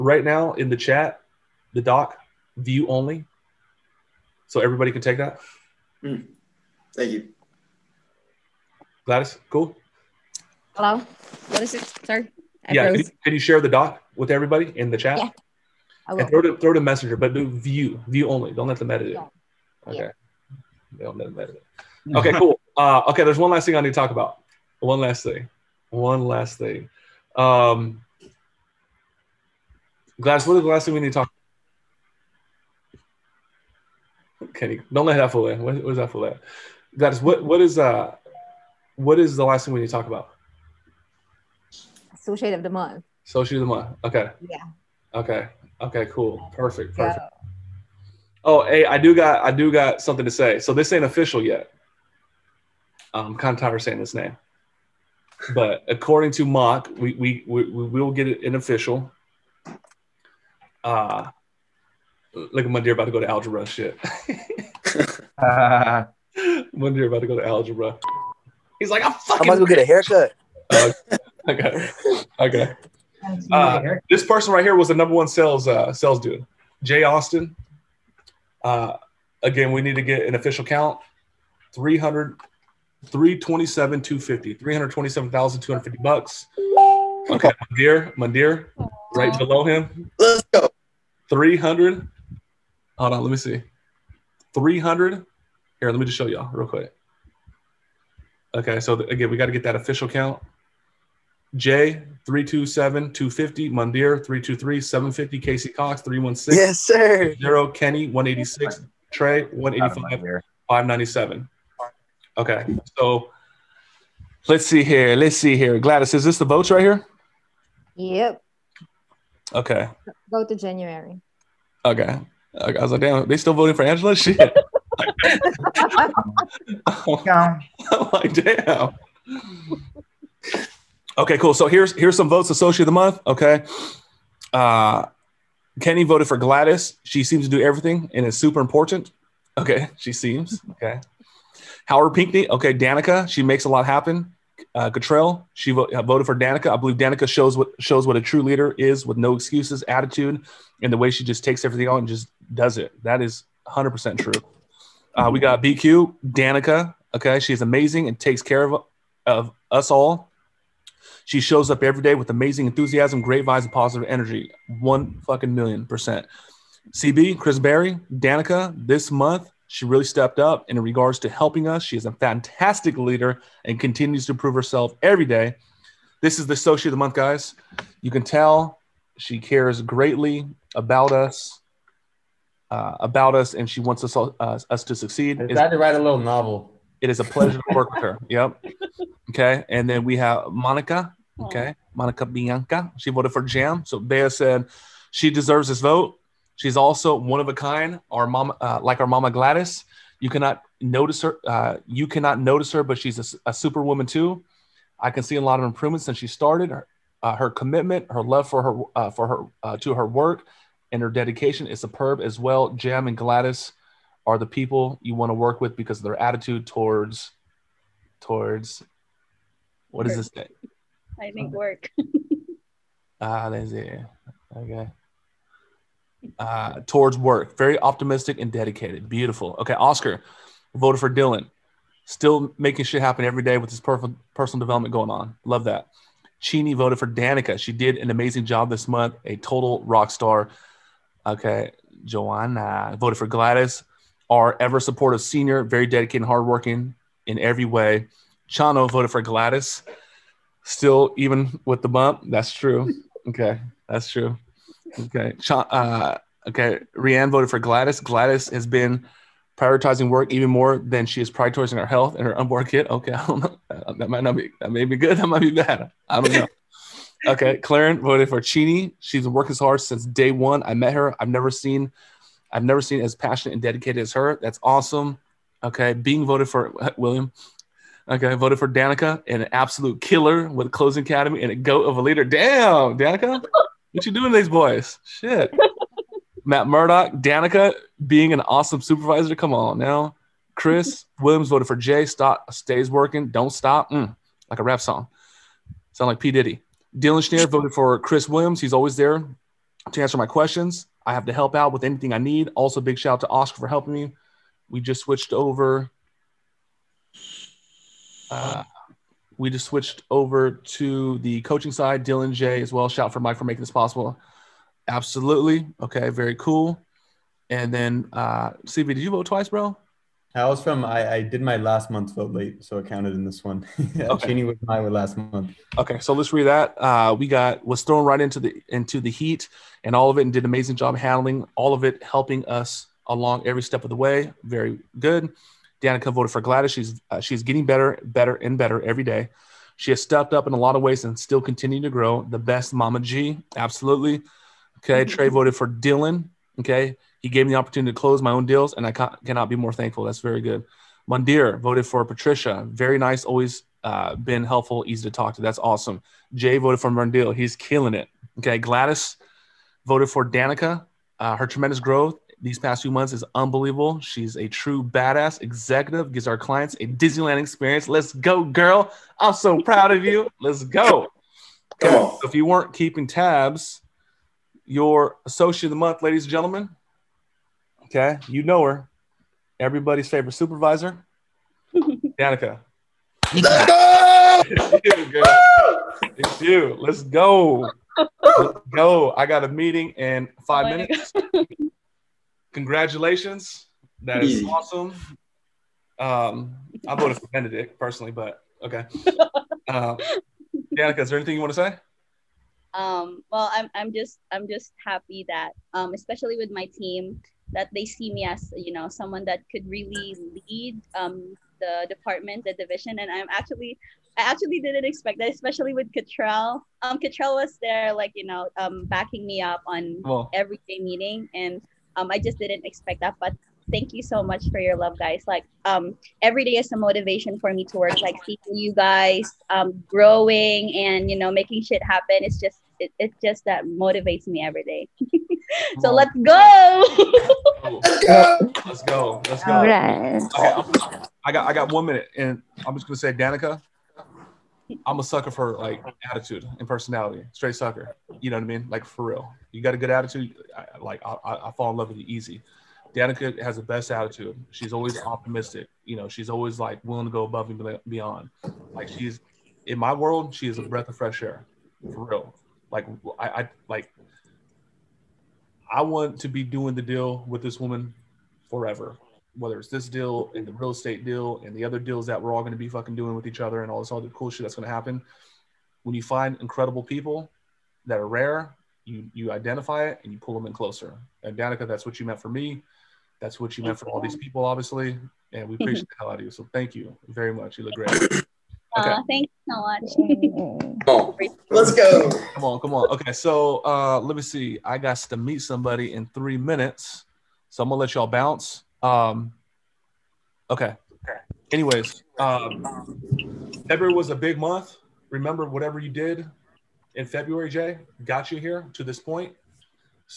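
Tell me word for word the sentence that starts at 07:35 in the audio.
You know, she's always like willing to go above and beyond.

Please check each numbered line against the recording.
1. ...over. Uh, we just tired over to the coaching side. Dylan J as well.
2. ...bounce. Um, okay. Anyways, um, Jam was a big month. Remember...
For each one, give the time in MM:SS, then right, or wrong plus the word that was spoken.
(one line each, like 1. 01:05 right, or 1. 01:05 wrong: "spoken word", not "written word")
1. 05:05 wrong: "switched", not "tired"
2. 08:18 wrong: "February", not "Jam".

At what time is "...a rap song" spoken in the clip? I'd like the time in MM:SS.
04:54.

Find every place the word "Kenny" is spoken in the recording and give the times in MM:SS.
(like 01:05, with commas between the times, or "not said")
00:34, 01:47, 02:15.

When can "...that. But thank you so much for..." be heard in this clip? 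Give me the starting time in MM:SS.
07:03.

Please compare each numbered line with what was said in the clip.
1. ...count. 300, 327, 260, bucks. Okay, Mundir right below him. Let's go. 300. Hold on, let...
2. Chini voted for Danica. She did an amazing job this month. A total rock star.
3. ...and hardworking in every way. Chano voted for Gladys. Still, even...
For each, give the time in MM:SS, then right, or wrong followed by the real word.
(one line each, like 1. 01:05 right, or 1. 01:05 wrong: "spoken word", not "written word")
1. 01:20 wrong: "250", not "260"
2. 03:56 right
3. 04:06 right.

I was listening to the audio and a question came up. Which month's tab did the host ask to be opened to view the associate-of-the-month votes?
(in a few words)
January.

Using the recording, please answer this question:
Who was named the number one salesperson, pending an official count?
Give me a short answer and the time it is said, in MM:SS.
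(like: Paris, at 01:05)
Jay Austin, at 01:16.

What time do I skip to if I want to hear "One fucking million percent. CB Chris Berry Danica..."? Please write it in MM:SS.
02:44.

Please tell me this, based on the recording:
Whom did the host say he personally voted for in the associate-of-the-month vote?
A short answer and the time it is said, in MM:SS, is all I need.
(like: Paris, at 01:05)
Benedict, at 06:37.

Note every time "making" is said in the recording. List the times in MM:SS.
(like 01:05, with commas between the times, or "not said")
03:52, 05:13, 07:11.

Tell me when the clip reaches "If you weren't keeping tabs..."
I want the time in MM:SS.
06:12.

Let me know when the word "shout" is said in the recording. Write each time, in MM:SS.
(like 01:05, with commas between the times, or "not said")
05:02, 05:12.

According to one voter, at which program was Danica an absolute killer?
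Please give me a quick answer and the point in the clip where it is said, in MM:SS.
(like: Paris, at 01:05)
Closing Academy, at 04:40.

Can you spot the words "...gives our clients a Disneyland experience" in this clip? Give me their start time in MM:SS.
06:06.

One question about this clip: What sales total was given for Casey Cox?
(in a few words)
316.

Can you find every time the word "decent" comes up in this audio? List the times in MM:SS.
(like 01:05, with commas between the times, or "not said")
not said.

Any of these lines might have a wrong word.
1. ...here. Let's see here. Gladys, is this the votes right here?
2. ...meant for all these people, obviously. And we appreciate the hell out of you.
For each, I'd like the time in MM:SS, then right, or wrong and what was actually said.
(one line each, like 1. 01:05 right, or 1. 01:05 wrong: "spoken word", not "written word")
1. 01:54 right
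2. 08:03 right.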